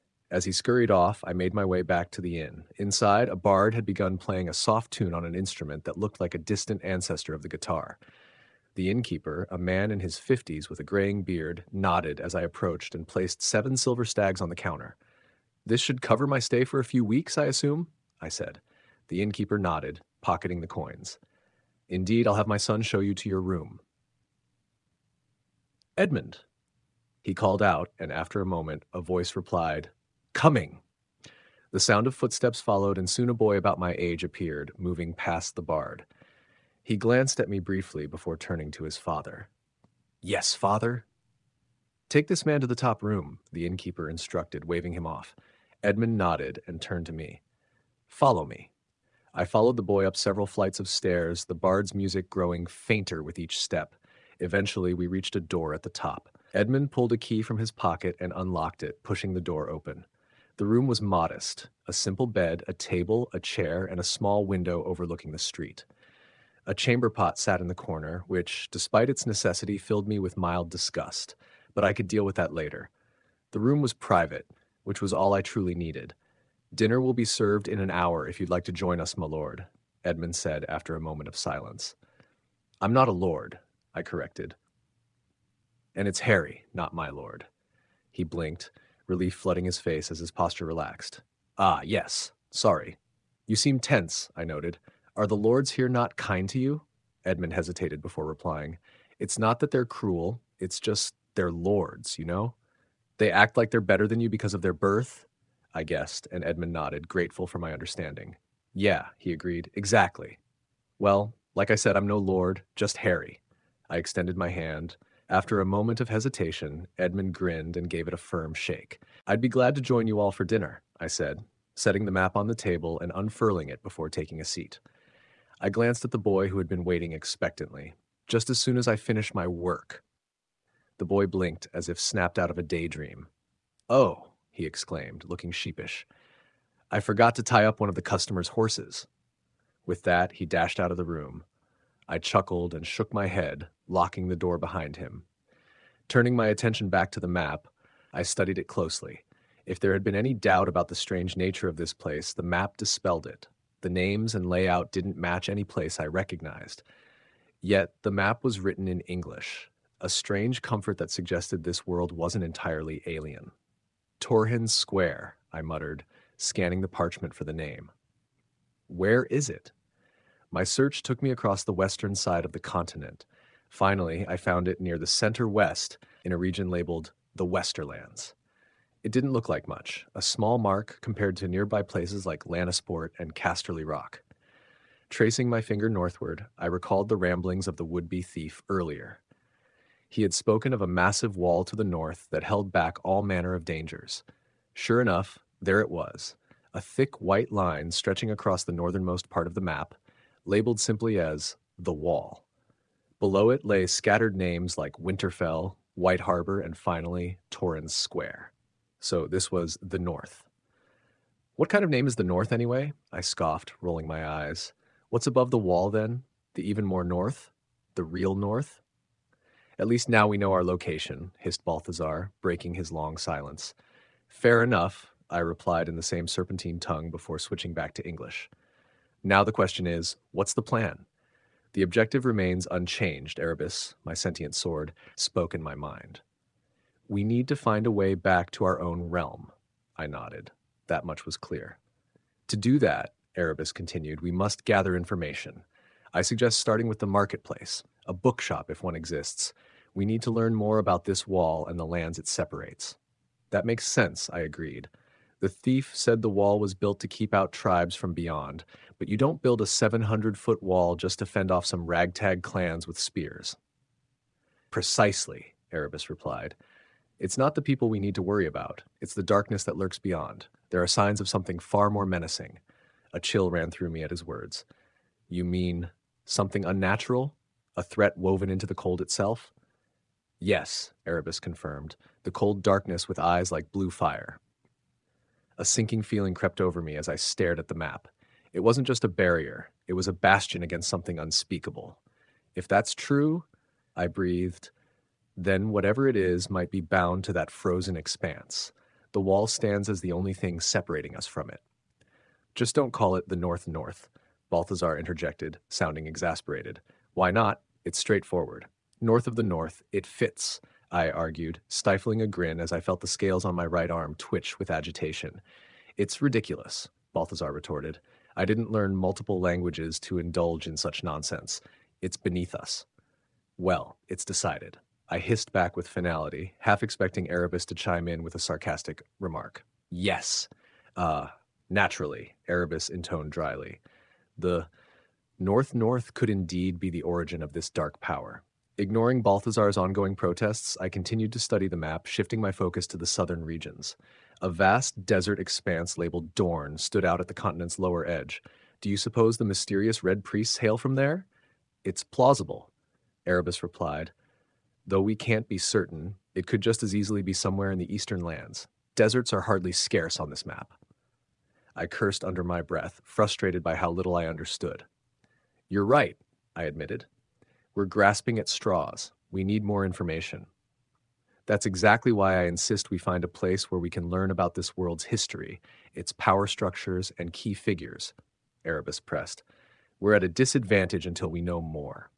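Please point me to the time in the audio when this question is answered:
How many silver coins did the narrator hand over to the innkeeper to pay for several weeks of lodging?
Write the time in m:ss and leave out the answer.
0:13.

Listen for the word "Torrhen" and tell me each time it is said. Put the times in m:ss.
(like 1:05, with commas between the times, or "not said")
2:44, 3:27.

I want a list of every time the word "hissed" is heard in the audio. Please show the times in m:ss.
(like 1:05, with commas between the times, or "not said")
3:41, 5:25.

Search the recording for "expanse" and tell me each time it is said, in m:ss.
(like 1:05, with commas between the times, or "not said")
4:57, 5:45.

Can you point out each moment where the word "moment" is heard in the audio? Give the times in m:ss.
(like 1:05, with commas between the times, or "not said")
0:28, 1:20, 1:55.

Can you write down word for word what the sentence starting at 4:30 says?
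There are signs of something far more menacing.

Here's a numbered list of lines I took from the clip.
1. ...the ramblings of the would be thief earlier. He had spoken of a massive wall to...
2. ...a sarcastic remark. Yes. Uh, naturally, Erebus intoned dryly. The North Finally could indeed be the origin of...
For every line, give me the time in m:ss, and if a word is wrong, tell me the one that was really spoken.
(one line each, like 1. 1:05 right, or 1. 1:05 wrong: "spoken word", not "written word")
1. 3:07 right
2. 5:28 wrong: "North", not "Finally".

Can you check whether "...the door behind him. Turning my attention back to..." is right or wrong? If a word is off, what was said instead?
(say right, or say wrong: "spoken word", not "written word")
right.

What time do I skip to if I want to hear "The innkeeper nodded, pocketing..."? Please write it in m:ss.
0:19.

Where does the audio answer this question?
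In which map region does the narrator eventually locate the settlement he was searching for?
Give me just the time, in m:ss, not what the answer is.
2:57.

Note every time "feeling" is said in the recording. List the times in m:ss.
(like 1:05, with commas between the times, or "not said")
4:46.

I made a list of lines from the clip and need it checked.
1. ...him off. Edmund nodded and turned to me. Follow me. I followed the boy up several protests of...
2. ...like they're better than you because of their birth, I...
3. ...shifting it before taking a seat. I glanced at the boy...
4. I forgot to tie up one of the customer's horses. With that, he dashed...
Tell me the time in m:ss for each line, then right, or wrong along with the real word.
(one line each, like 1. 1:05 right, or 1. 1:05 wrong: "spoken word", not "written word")
1. 0:44 wrong: "flights", not "protests"
2. 1:43 right
3. 2:03 wrong: "unfurling", not "shifting"
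4. 2:16 right.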